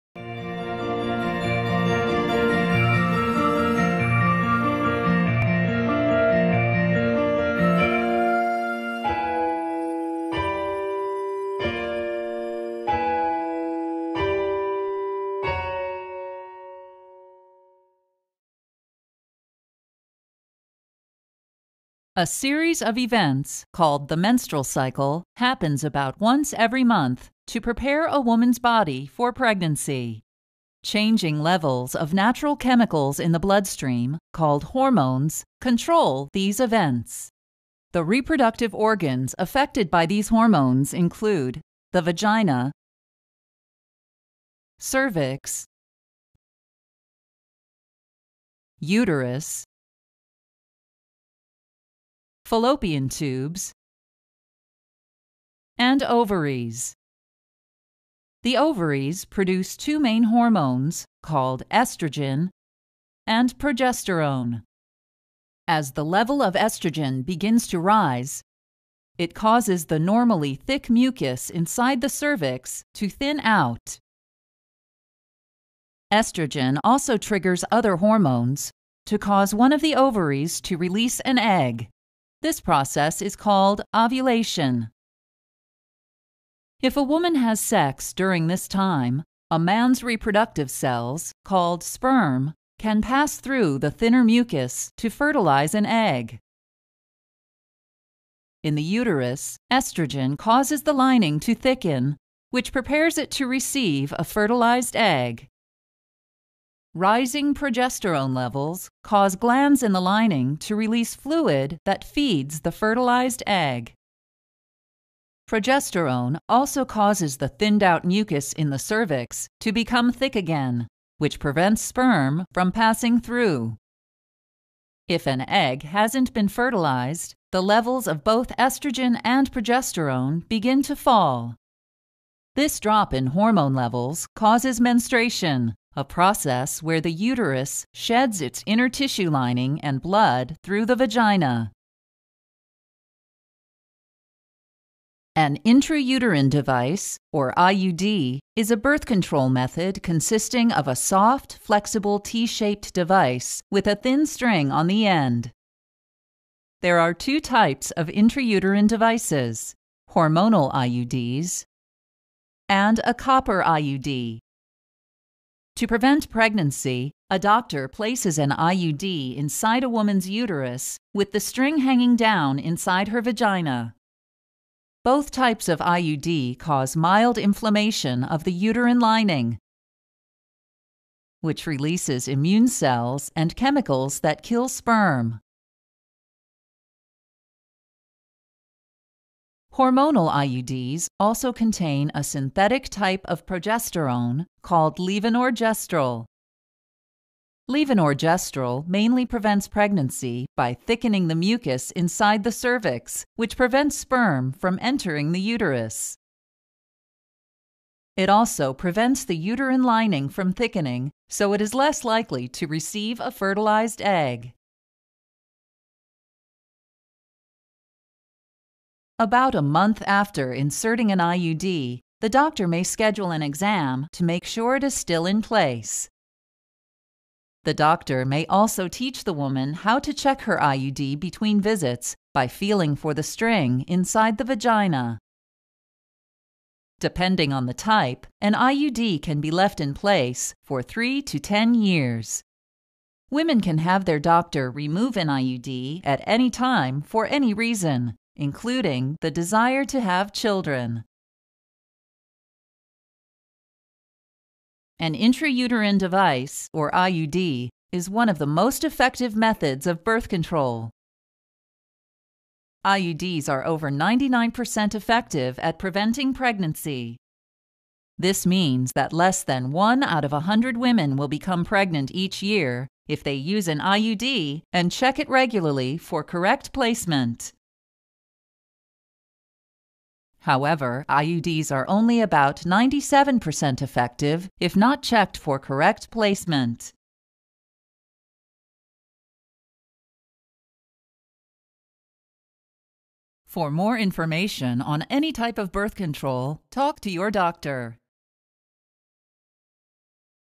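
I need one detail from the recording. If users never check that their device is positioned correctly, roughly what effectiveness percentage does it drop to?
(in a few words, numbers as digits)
97%.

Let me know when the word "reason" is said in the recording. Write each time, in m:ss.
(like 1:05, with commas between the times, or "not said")
4:07.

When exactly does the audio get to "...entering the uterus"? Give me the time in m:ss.
3:24.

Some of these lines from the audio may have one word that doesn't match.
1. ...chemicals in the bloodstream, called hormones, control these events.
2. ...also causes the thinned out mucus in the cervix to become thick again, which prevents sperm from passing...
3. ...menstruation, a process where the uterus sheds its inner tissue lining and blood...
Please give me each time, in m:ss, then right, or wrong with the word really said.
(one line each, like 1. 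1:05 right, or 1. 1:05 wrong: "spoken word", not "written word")
1. 0:32 right
2. 1:56 right
3. 2:14 right.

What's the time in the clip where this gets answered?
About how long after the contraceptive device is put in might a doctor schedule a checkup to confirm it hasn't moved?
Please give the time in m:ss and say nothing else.
3:39.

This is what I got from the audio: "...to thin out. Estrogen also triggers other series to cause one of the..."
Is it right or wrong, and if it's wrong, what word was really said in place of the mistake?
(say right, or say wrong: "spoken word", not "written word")
wrong: "hormones", not "series".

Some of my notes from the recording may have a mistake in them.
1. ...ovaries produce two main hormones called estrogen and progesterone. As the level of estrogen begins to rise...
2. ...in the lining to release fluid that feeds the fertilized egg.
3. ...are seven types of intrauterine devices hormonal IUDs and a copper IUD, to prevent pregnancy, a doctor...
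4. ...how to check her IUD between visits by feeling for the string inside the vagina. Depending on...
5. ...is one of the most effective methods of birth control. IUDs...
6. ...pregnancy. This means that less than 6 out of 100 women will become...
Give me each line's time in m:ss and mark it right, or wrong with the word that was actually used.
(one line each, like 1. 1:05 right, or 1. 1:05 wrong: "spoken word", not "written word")
1. 0:58 right
2. 1:49 right
3. 2:36 wrong: "two", not "seven"
4. 3:49 right
5. 4:17 right
6. 4:26 wrong: "1", not "6".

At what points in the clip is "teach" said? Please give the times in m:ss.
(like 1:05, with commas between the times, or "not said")
3:48.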